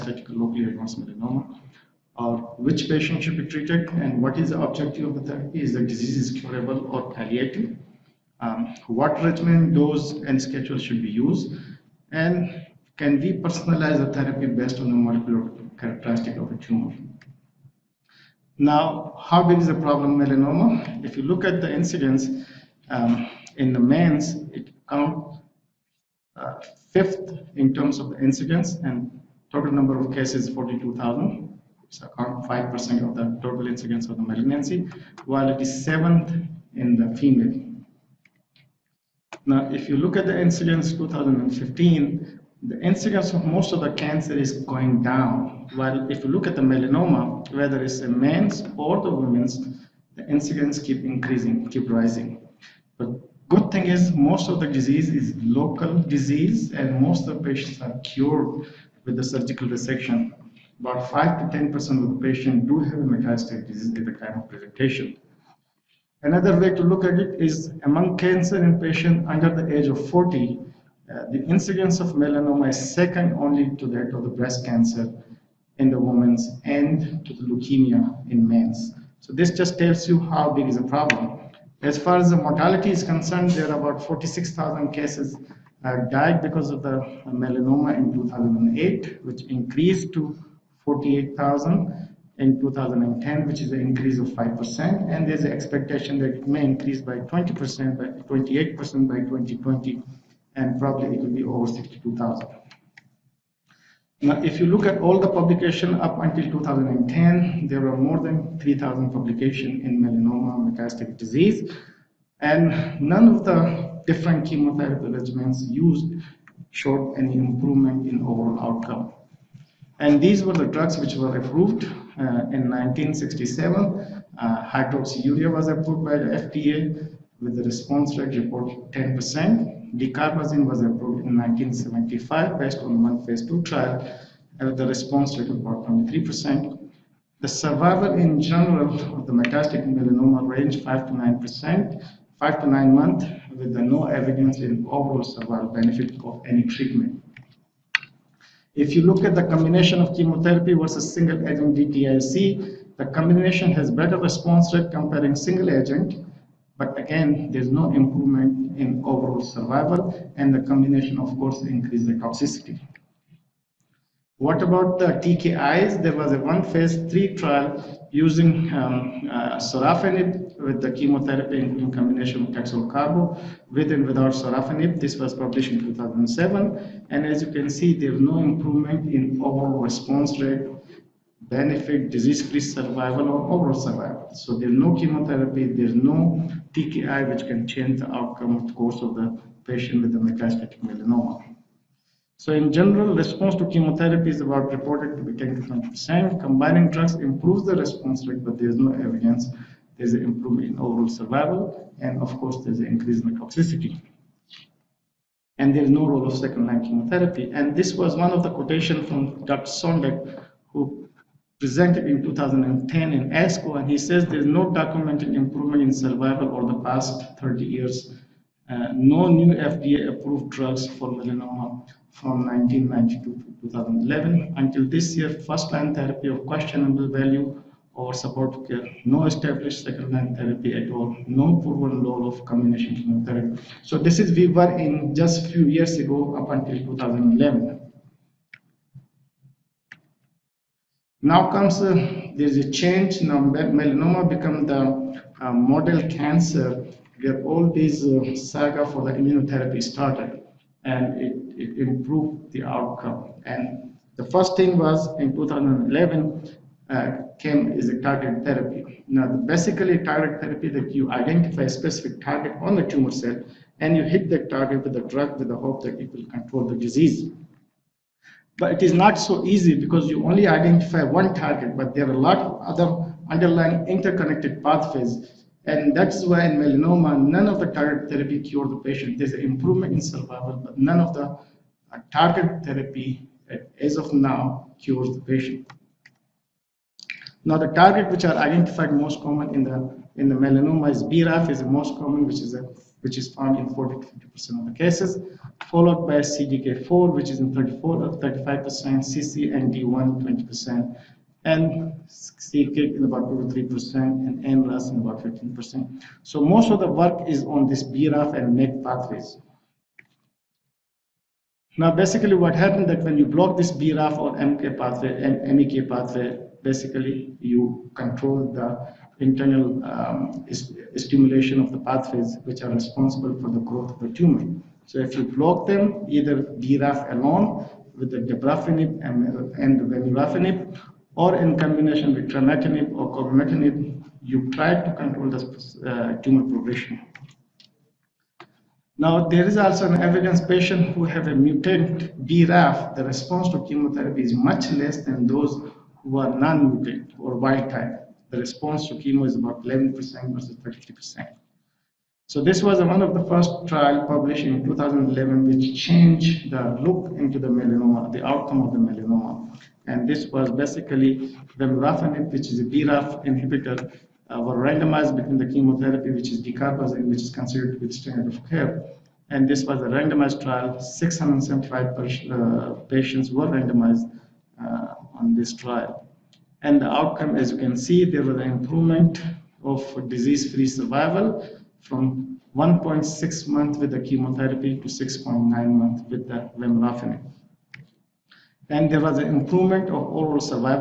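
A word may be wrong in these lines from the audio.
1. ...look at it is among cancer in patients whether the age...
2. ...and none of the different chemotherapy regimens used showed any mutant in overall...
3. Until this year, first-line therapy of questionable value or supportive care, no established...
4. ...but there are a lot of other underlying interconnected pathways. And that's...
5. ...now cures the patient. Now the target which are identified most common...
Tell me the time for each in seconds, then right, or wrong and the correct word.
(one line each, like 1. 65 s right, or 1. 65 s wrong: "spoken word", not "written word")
1. 66 s wrong: "under", not "whether"
2. 112 s wrong: "improvement", not "mutant"
3. 224 s right
4. 271 s right
5. 284 s right.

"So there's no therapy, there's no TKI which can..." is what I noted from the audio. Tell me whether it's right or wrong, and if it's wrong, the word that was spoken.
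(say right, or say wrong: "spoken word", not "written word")
wrong: "chemotherapy", not "therapy".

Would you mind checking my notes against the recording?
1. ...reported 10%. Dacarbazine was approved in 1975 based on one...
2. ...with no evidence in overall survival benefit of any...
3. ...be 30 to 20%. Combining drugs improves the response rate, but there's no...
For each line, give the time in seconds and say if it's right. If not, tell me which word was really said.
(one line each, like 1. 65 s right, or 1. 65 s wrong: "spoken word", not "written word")
1. 128 s right
2. 143 s right
3. 195 s wrong: "10", not "30".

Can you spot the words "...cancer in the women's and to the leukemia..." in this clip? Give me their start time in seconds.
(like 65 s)
74 s.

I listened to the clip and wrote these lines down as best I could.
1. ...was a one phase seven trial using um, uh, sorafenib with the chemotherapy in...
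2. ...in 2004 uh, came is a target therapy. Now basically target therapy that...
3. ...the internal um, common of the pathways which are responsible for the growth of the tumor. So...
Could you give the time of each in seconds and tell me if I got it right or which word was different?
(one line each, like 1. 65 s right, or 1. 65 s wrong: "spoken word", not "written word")
1. 166 s wrong: "three", not "seven"
2. 255 s wrong: "2011", not "2004"
3. 318 s wrong: "stimulation", not "common".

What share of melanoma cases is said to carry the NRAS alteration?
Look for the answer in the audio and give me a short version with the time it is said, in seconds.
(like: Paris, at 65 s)
15%, at 305 s.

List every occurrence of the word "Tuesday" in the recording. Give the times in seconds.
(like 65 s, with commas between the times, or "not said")
not said.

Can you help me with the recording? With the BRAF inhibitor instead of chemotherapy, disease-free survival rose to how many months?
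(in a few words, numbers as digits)
6.9 months.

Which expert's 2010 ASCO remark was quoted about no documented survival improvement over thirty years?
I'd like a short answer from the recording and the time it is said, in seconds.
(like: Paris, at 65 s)
Dr. Sondak, at 209 s.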